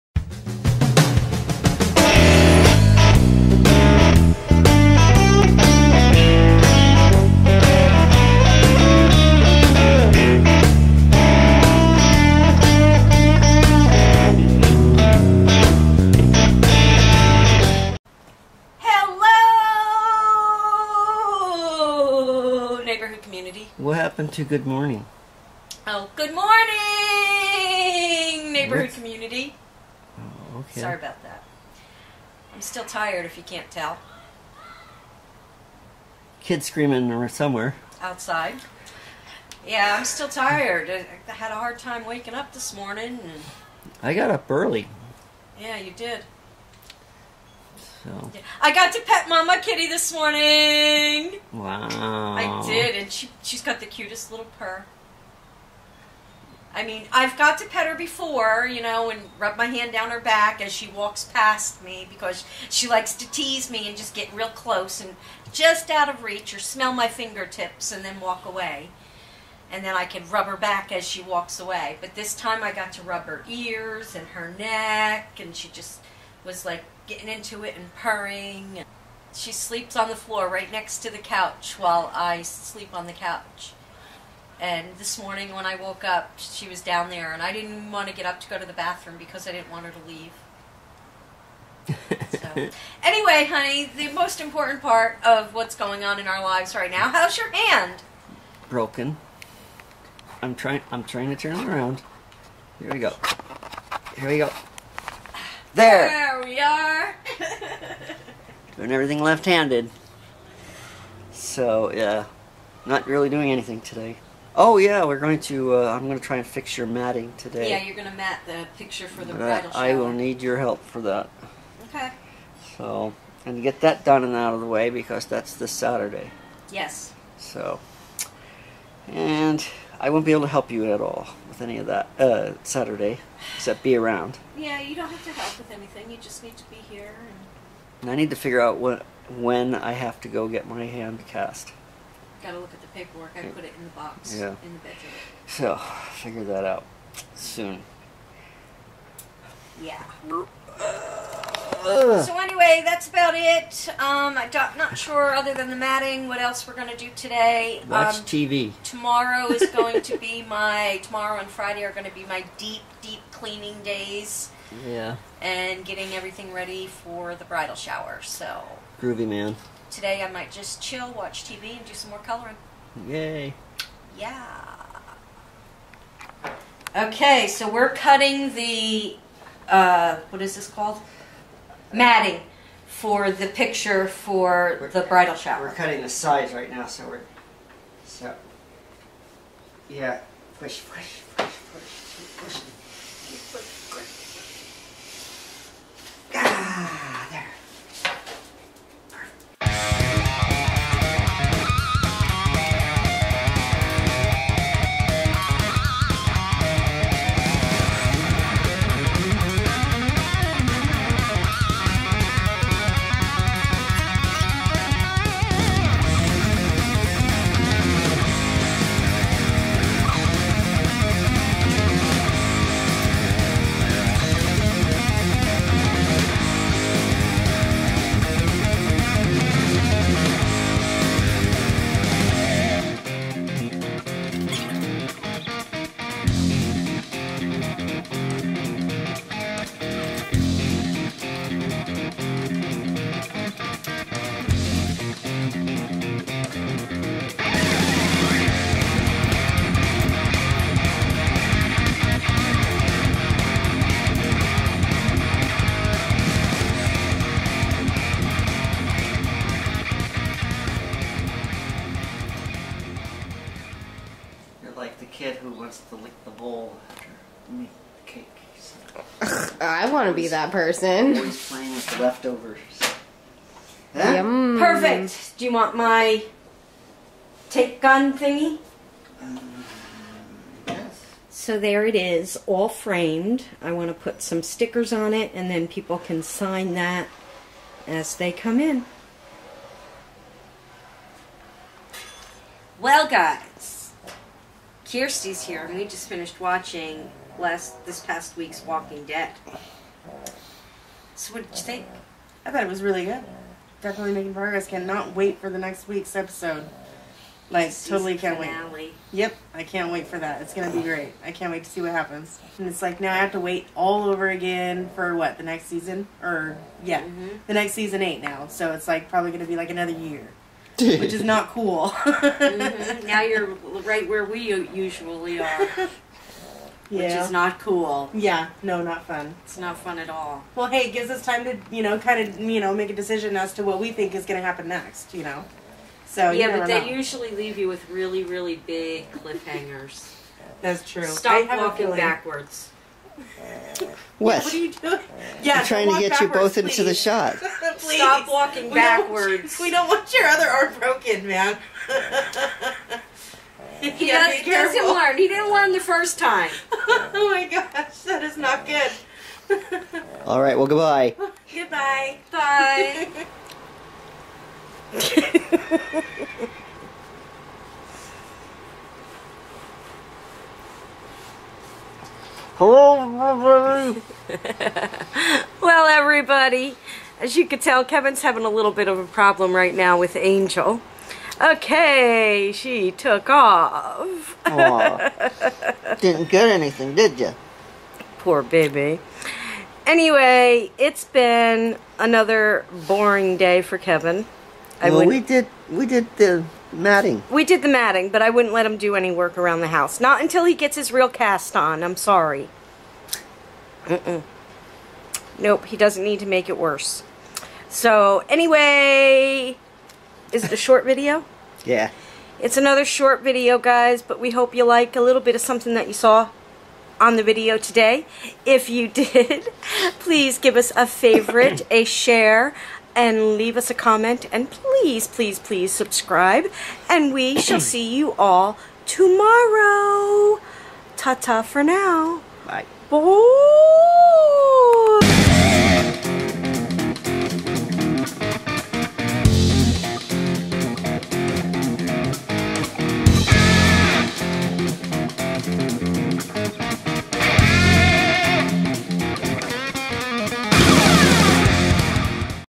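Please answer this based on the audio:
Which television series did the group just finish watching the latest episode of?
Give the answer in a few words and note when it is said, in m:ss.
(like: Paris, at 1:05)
Walking Dead, at 4:58.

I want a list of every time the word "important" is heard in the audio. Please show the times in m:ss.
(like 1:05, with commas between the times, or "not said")
1:34.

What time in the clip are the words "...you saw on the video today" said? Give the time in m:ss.
6:55.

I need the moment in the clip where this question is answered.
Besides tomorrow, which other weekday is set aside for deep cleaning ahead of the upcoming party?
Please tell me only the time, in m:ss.
2:41.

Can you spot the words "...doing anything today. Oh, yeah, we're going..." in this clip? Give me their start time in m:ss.
1:53.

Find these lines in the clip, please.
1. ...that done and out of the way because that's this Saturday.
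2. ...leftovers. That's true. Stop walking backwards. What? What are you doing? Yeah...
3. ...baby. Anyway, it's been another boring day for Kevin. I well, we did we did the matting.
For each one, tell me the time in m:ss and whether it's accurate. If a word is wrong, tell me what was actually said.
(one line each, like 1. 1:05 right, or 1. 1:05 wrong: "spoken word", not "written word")
1. 2:03 right
2. 5:39 wrong: "cliffhangers", not "leftovers"
3. 6:28 right.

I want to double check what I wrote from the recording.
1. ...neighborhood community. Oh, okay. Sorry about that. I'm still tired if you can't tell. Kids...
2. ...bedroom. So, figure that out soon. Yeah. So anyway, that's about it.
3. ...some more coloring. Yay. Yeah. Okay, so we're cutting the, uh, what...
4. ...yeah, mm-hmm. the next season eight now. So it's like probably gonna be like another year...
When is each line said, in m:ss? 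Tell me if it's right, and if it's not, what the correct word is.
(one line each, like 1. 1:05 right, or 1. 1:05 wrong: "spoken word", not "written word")
1. 0:28 right
2. 2:24 right
3. 2:51 right
4. 5:16 right.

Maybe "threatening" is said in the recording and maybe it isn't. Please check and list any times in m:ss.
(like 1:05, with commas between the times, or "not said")
not said.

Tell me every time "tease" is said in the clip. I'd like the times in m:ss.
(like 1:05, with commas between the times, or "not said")
1:03.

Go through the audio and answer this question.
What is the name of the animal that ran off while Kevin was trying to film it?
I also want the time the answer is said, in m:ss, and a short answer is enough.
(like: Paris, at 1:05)
Angel, at 6:20.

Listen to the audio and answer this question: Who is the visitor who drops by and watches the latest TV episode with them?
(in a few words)
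Kirsty.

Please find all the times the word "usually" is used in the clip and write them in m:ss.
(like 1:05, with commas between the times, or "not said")
5:24, 5:36.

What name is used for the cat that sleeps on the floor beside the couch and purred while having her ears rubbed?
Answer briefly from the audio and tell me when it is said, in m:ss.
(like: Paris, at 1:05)
Mama Kitty, at 0:49.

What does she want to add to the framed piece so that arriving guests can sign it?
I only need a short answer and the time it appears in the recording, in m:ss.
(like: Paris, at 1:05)
stickers, at 4:44.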